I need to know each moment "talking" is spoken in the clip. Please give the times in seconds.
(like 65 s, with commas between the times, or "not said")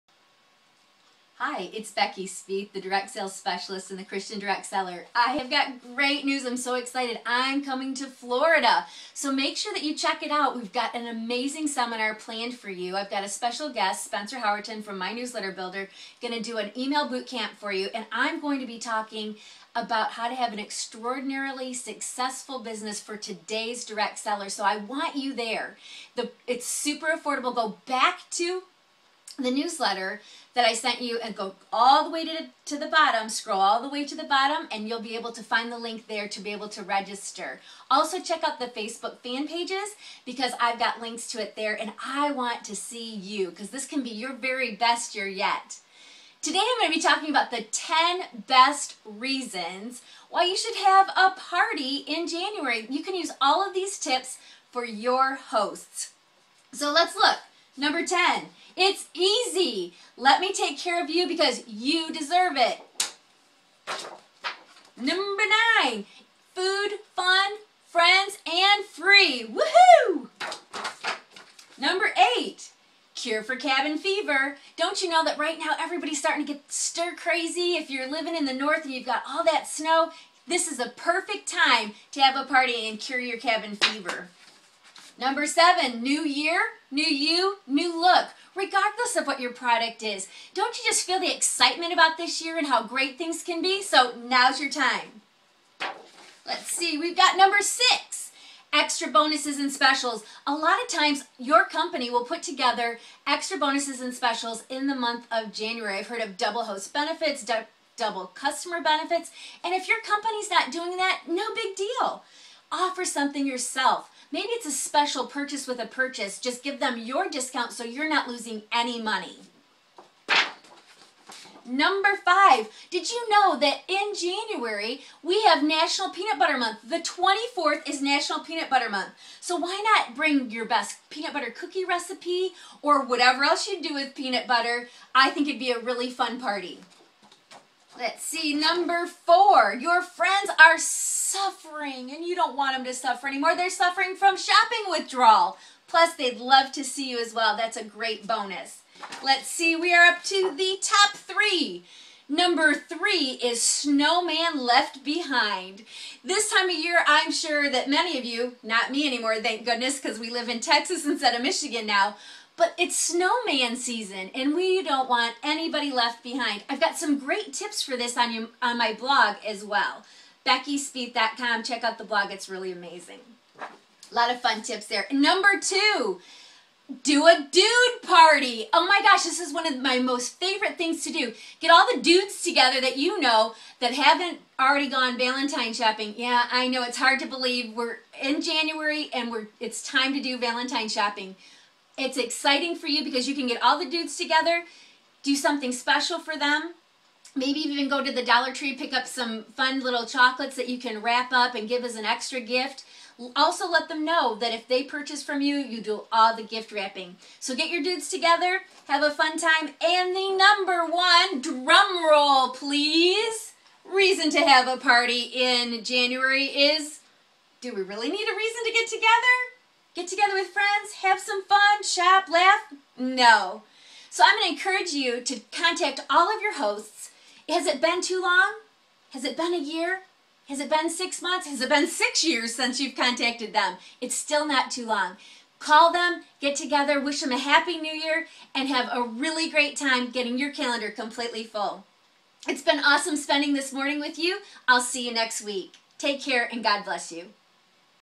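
18 s, 47 s.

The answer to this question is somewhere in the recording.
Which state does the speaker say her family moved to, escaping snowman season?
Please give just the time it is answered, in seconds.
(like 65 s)
160 s.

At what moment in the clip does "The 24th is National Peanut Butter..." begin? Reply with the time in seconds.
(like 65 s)
126 s.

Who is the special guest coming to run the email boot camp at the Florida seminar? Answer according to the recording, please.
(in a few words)
Spencer Howerton.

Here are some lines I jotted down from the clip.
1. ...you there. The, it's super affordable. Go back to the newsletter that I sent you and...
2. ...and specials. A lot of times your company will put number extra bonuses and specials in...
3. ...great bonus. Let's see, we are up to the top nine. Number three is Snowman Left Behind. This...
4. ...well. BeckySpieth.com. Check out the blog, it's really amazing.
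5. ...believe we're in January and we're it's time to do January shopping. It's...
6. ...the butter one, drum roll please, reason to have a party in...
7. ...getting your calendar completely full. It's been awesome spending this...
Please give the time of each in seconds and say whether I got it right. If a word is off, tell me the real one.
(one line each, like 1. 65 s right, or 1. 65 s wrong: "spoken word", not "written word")
1. 25 s right
2. 99 s wrong: "together", not "number"
3. 147 s wrong: "three", not "nine"
4. 169 s right
5. 187 s wrong: "Valentine", not "January"
6. 210 s wrong: "number", not "butter"
7. 240 s right.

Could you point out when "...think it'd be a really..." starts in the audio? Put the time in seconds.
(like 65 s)
135 s.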